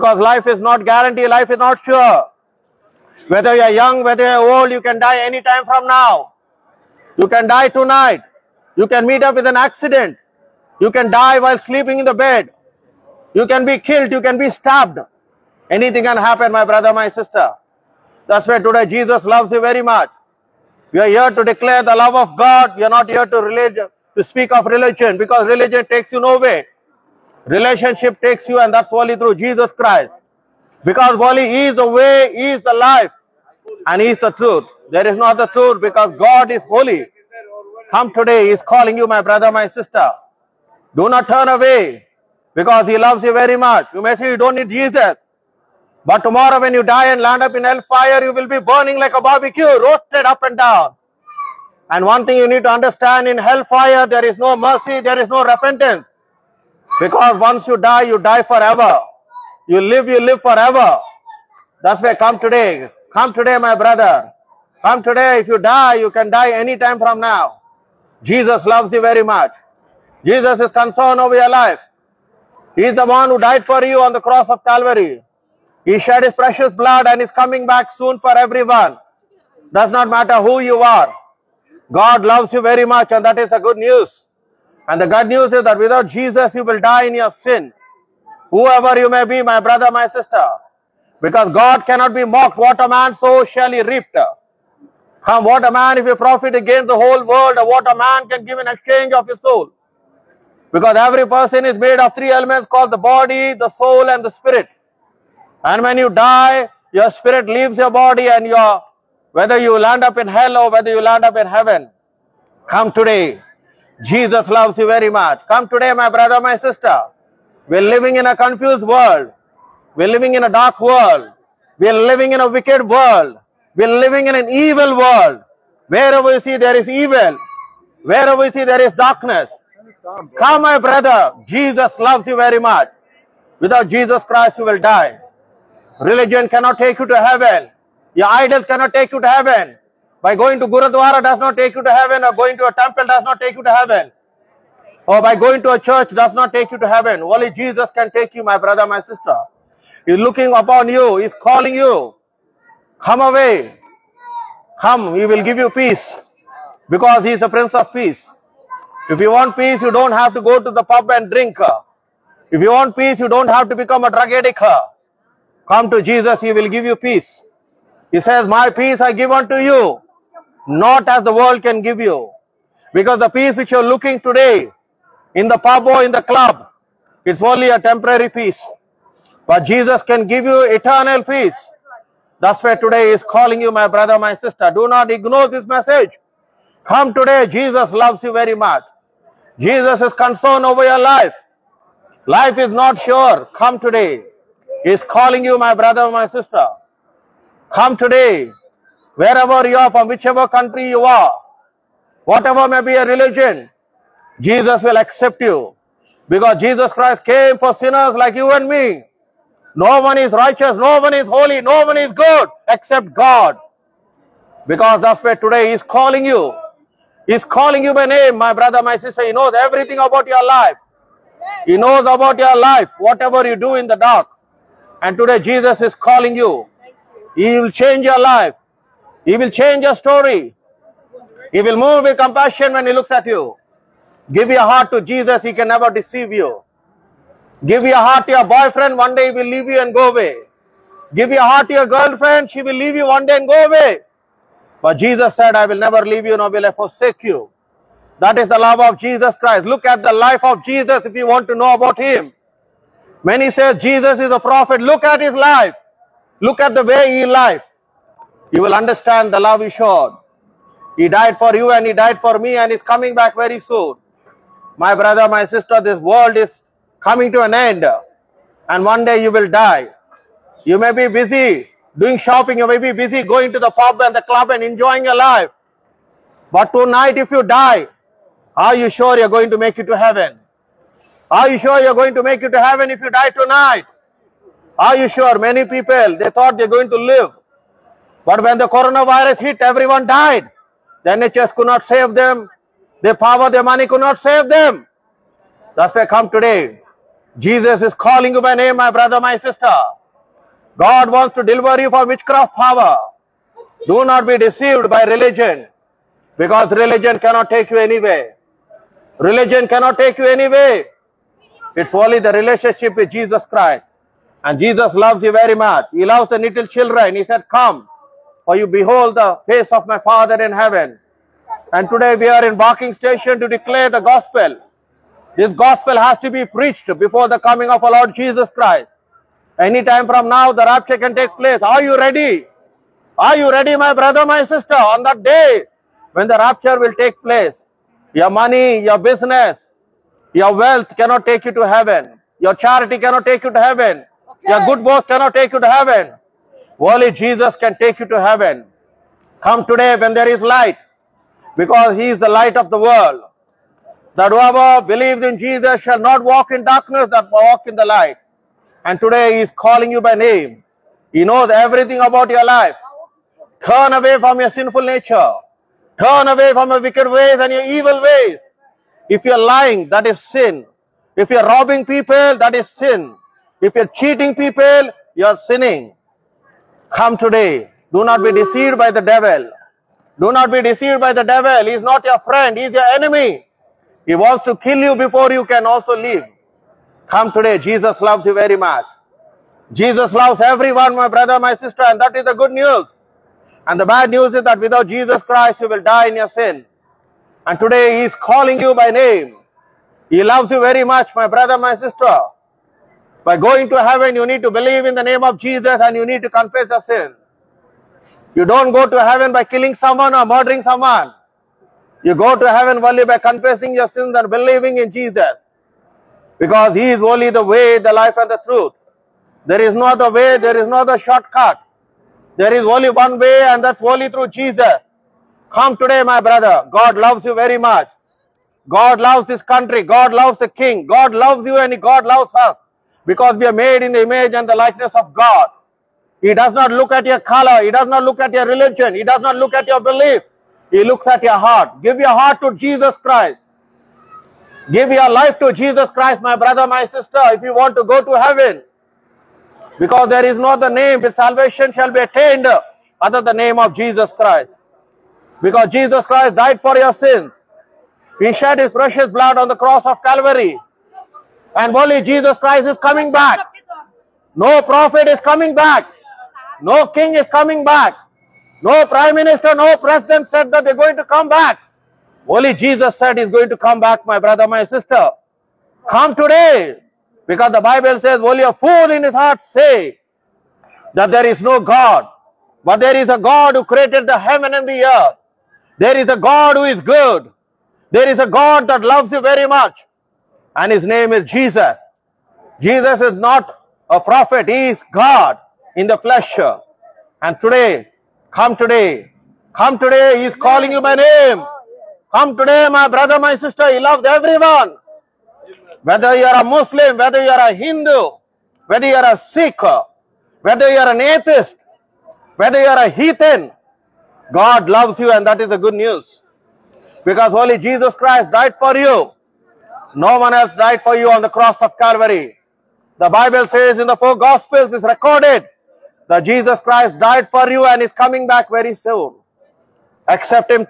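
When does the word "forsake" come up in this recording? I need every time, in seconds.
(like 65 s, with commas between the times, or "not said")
246 s.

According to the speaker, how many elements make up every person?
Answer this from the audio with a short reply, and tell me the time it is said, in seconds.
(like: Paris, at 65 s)
3, at 102 s.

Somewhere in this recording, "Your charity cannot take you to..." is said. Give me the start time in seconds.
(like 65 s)
342 s.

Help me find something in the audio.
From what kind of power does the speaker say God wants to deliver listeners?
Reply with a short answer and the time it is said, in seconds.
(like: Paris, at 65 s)
witchcraft power, at 302 s.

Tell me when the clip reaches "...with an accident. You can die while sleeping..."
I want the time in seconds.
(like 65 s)
9 s.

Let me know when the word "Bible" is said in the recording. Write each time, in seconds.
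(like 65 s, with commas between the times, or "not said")
477 s, 523 s.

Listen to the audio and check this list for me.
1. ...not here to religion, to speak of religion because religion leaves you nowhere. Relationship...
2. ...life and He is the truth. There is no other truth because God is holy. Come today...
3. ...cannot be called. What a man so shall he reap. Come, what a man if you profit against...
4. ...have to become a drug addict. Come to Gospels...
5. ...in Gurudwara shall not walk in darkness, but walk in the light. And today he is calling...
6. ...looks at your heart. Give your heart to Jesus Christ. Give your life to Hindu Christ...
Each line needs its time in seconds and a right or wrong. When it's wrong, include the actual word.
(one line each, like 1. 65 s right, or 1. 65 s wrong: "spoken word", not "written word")
1. 22 s wrong: "takes", not "leaves"
2. 32 s right
3. 91 s wrong: "mocked", not "called"
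4. 163 s wrong: "Jesus", not "Gospels"
5. 355 s wrong: "Jesus", not "Gurudwara"
6. 440 s wrong: "Jesus", not "Hindu".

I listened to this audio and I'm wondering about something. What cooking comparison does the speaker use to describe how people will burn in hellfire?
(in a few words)
like a barbecue.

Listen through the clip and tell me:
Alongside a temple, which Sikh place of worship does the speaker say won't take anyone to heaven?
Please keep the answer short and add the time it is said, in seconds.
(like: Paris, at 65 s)
Gurudwara, at 140 s.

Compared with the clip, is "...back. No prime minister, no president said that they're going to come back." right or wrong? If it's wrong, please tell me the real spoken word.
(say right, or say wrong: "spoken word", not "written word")
right.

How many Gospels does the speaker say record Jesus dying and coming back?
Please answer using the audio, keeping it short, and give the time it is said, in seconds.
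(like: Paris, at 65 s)
4, at 523 s.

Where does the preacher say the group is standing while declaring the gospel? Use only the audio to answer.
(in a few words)
Barking station.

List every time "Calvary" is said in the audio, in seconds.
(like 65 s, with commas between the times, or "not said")
74 s, 460 s, 521 s.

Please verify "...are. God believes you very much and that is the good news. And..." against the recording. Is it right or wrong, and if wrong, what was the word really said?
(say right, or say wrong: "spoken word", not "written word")
wrong: "loves", not "believes".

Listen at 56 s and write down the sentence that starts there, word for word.
Because once you die, you die forever.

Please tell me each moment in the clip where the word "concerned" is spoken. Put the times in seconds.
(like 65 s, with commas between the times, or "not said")
70 s, 190 s.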